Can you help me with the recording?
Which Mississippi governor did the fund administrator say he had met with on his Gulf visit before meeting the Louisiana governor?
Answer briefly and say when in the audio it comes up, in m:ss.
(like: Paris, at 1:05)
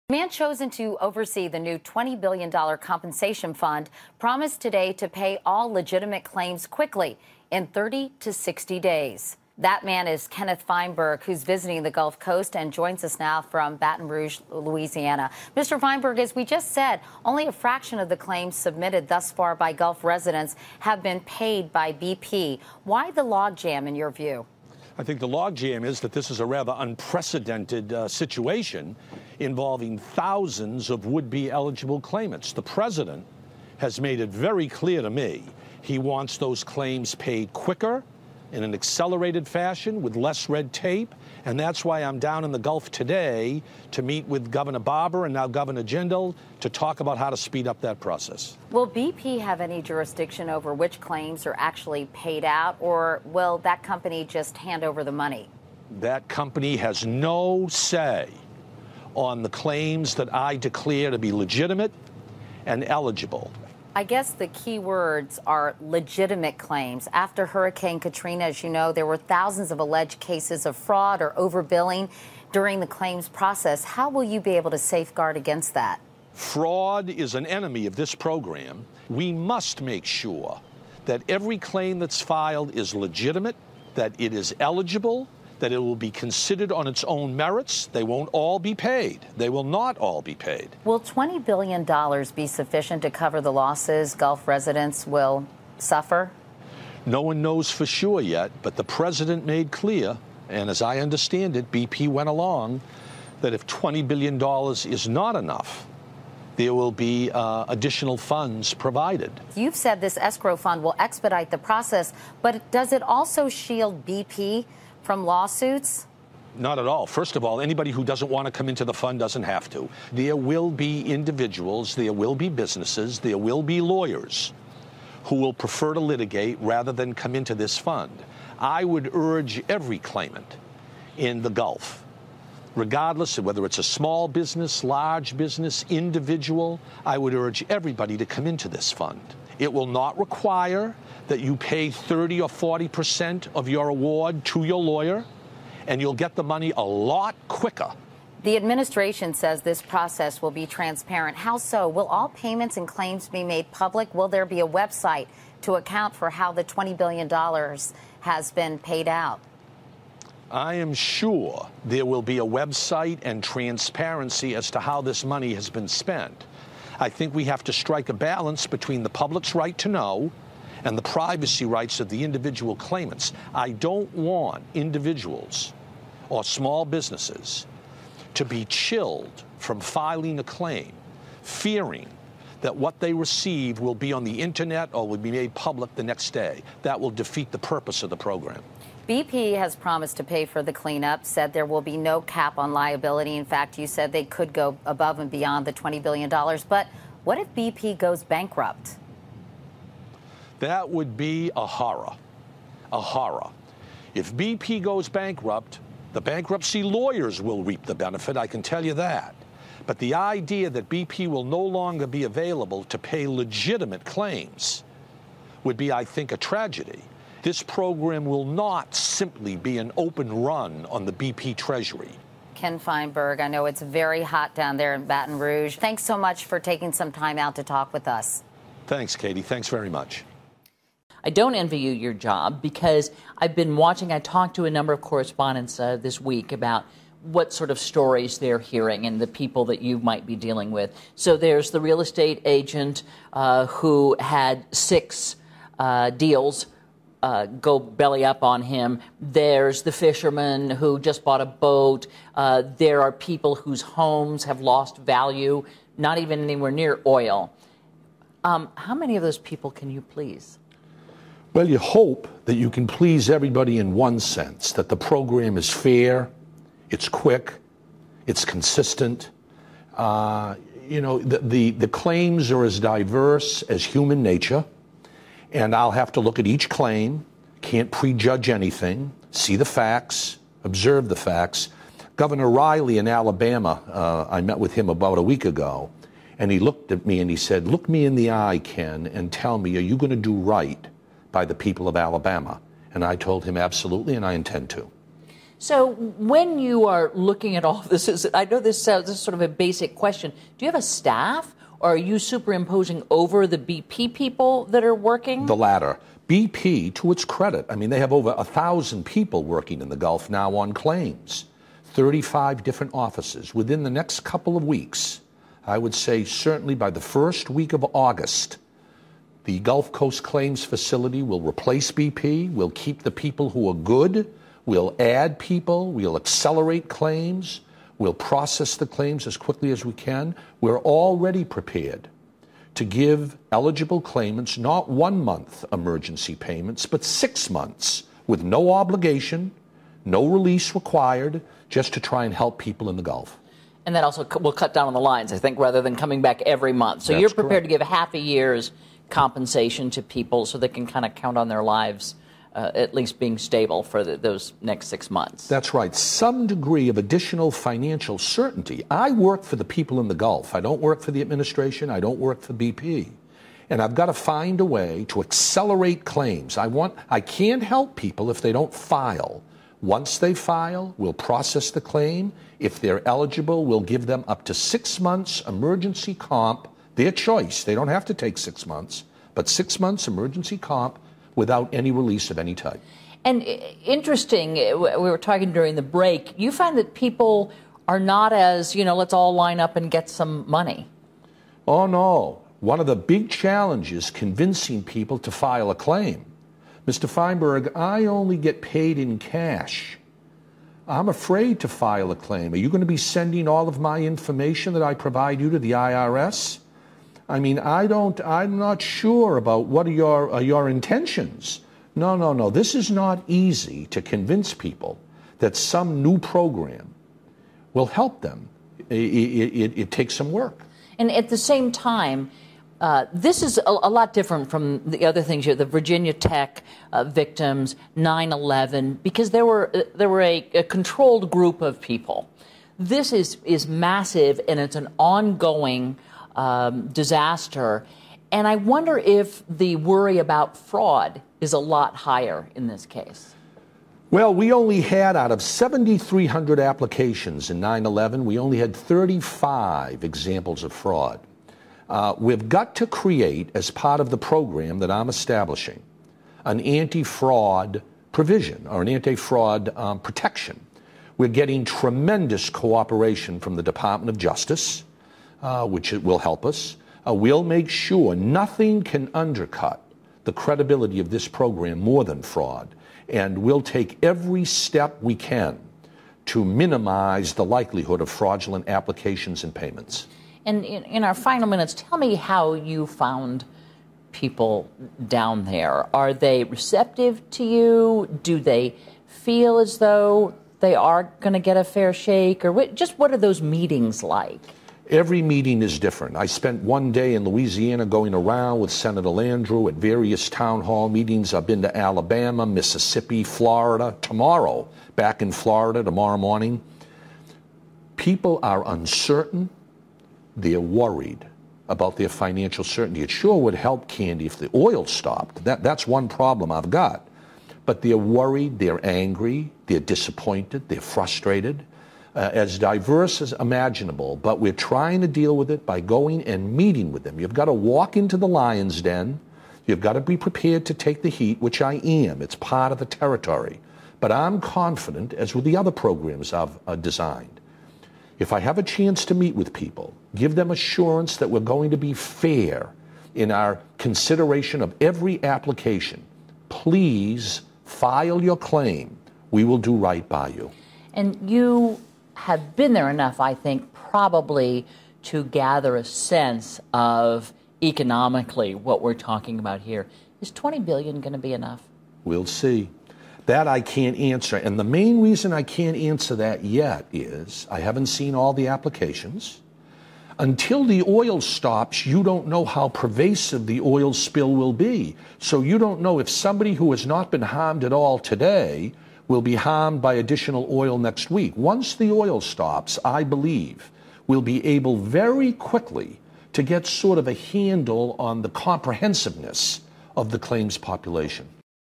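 Governor Barbour, at 0:44.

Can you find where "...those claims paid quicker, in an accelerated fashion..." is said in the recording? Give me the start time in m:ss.
0:36.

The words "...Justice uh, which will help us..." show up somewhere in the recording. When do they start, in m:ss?
7:44.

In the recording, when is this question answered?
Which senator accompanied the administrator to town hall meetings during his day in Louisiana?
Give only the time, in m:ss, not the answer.
8:18.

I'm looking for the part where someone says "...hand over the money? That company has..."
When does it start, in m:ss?
0:54.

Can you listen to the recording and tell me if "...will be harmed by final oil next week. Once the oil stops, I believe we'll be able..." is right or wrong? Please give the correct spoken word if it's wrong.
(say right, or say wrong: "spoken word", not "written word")
wrong: "additional", not "final".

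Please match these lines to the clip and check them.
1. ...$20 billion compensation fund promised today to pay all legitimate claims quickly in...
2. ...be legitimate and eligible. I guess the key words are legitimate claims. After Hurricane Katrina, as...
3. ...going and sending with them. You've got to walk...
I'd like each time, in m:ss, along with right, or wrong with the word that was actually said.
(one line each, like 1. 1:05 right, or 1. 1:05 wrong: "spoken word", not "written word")
1. 0:01 right
2. 1:01 right
3. 8:45 wrong: "meeting", not "sending".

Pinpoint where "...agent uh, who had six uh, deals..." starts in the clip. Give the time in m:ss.
4:02.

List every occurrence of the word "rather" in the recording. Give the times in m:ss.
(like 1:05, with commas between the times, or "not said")
0:26, 2:06, 5:45.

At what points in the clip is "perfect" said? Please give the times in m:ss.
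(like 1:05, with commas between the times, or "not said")
not said.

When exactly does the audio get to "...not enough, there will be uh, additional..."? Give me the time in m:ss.
1:45.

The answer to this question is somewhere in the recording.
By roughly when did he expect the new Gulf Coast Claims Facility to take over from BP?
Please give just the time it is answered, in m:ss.
5:17.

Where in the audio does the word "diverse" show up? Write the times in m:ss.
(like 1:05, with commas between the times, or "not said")
4:32, 8:42.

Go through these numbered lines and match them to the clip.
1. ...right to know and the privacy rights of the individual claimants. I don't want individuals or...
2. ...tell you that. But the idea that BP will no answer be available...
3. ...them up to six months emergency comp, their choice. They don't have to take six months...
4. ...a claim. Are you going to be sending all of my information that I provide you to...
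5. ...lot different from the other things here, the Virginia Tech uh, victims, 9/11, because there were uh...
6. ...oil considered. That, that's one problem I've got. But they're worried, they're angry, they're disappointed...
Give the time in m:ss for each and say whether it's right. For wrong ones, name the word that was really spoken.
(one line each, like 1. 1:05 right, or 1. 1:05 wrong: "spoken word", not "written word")
1. 2:49 right
2. 3:28 wrong: "longer", not "answer"
3. 6:14 right
4. 6:42 right
5. 7:03 right
6. 8:34 wrong: "stopped", not "considered".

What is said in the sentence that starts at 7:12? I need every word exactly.
This is is massive, and it's an ongoing um, disaster.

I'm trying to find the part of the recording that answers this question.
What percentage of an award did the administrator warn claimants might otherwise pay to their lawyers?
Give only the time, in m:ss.
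2:21.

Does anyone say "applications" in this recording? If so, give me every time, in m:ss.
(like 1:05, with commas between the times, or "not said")
7:26, 7:58, 9:05, 9:28.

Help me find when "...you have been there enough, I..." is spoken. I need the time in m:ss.
9:11.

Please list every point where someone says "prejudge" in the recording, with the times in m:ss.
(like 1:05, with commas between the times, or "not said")
4:37.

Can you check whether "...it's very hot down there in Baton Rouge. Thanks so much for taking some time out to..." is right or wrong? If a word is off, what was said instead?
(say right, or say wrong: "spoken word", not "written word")
right.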